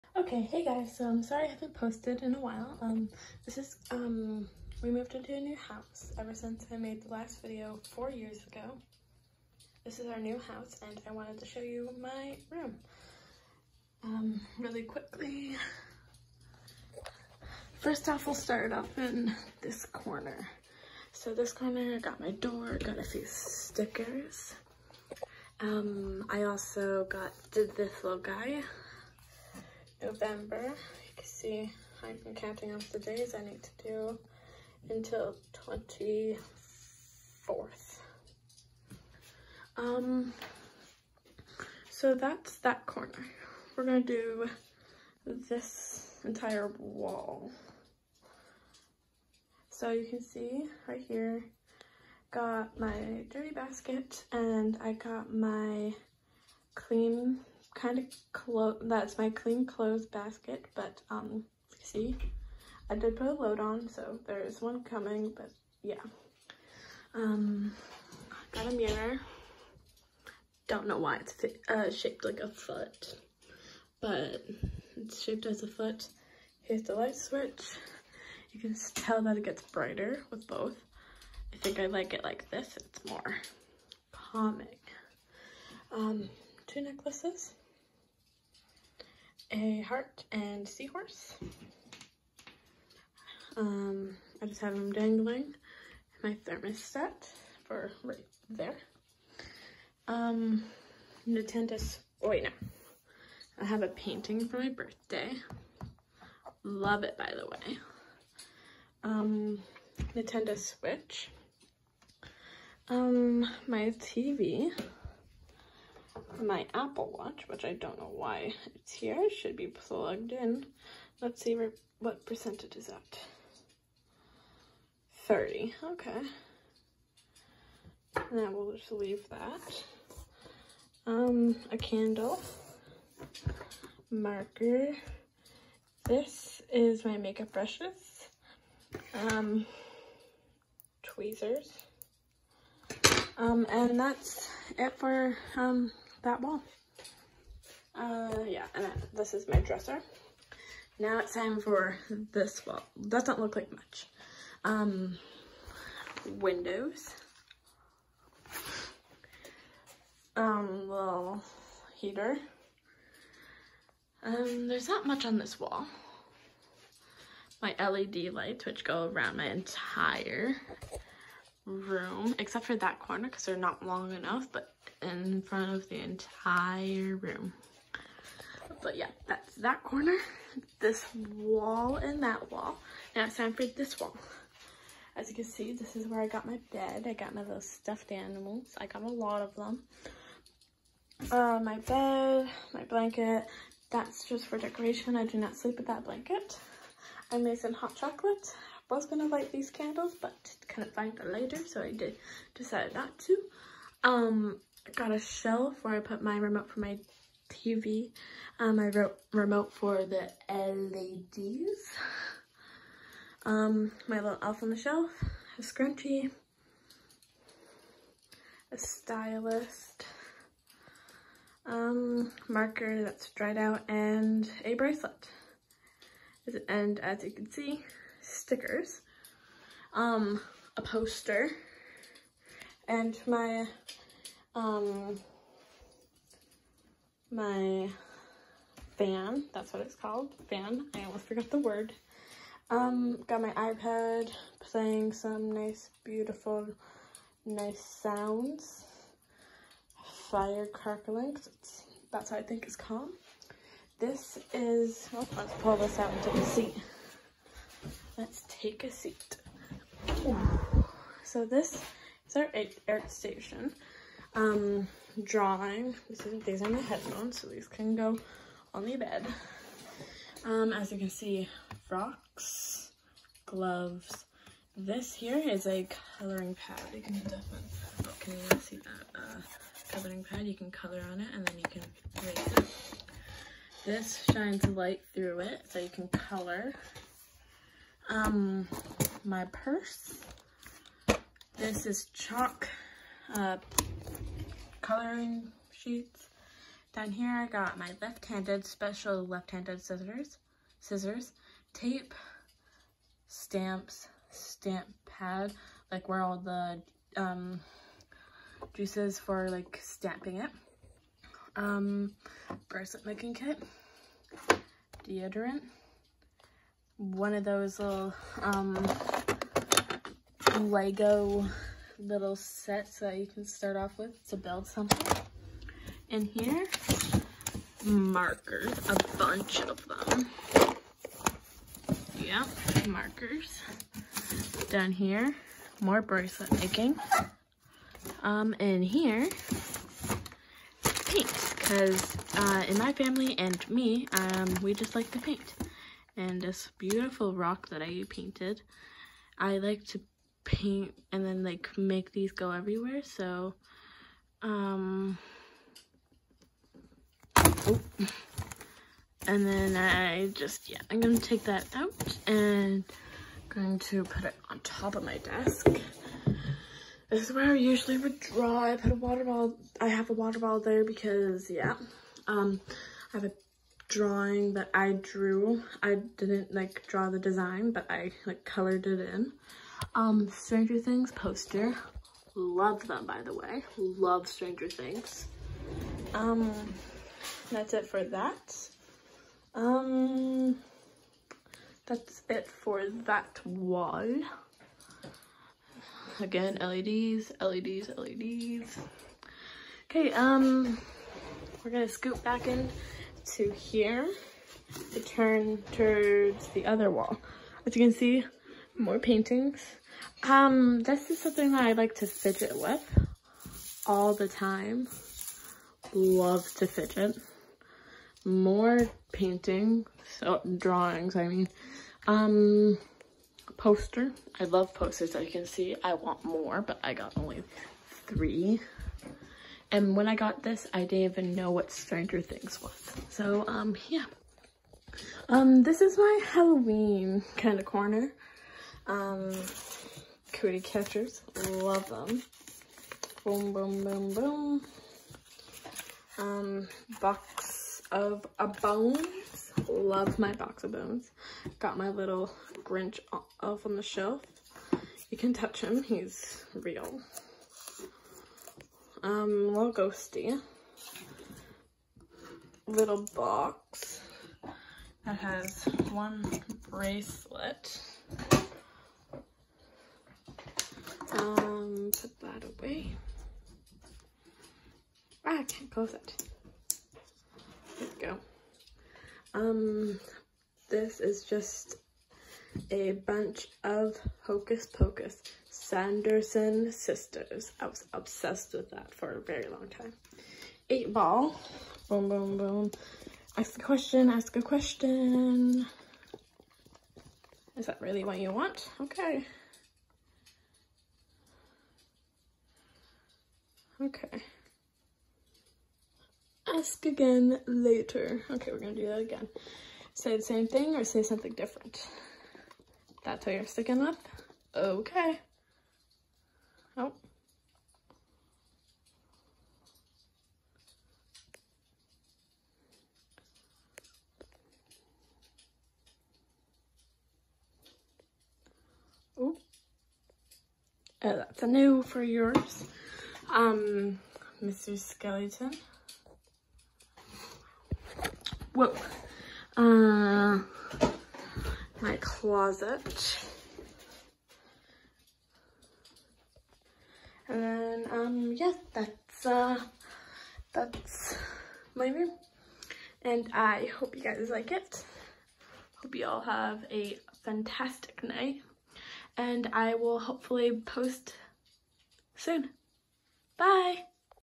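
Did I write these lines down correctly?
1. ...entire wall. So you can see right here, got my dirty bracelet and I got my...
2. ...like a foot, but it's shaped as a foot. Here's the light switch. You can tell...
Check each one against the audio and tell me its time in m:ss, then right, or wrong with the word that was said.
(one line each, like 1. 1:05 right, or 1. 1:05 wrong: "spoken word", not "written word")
1. 0:46 wrong: "basket", not "bracelet"
2. 1:12 right.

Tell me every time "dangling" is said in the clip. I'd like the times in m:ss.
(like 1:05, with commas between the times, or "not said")
1:34.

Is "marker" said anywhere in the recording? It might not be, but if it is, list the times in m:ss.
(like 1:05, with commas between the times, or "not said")
2:14, 3:42, 5:27, 5:32.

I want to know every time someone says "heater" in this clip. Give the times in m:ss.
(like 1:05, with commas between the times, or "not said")
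2:41.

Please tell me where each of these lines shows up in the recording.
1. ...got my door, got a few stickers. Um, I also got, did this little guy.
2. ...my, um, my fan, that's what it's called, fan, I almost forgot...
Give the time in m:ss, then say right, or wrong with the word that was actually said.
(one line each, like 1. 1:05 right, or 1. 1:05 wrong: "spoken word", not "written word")
1. 0:21 right
2. 3:53 right.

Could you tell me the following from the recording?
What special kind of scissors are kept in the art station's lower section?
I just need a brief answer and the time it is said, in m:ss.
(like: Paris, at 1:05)
Left-handed scissors, at 4:59.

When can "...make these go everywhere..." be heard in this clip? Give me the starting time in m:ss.
5:51.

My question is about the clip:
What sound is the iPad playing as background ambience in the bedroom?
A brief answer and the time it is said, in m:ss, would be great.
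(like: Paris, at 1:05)
Fire crackling, at 4:10.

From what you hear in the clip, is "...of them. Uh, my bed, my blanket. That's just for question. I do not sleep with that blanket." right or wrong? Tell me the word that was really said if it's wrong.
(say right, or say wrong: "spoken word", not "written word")
wrong: "decoration", not "question".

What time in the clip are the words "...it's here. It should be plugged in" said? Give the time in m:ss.
1:58.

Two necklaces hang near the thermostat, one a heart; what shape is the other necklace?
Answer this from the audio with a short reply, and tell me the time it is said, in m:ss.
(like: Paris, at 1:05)
Seahorse, at 1:30.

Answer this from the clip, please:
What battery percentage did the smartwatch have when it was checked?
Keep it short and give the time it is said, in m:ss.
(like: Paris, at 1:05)
30, at 2:05.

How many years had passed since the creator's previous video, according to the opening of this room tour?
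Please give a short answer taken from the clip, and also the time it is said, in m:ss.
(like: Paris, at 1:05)
4 years, at 0:07.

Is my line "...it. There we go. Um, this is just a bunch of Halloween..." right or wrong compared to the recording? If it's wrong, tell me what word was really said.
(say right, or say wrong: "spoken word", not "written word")
wrong: "Hocus", not "Halloween".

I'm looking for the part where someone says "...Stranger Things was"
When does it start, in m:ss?
7:11.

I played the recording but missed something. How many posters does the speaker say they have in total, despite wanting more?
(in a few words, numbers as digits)
3.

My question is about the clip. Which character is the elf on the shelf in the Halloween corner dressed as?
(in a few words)
Grinch.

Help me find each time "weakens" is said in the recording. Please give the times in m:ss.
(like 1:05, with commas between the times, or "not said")
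not said.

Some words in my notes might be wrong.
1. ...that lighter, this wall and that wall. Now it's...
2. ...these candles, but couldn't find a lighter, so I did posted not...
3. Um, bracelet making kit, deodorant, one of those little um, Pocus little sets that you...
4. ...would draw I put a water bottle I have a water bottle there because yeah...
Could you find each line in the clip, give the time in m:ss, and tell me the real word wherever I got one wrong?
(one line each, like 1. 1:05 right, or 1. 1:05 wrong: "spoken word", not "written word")
1. 2:59 wrong: "corner", not "lighter"
2. 3:19 wrong: "decided", not "posted"
3. 5:11 wrong: "Lego", not "Pocus"
4. 6:07 right.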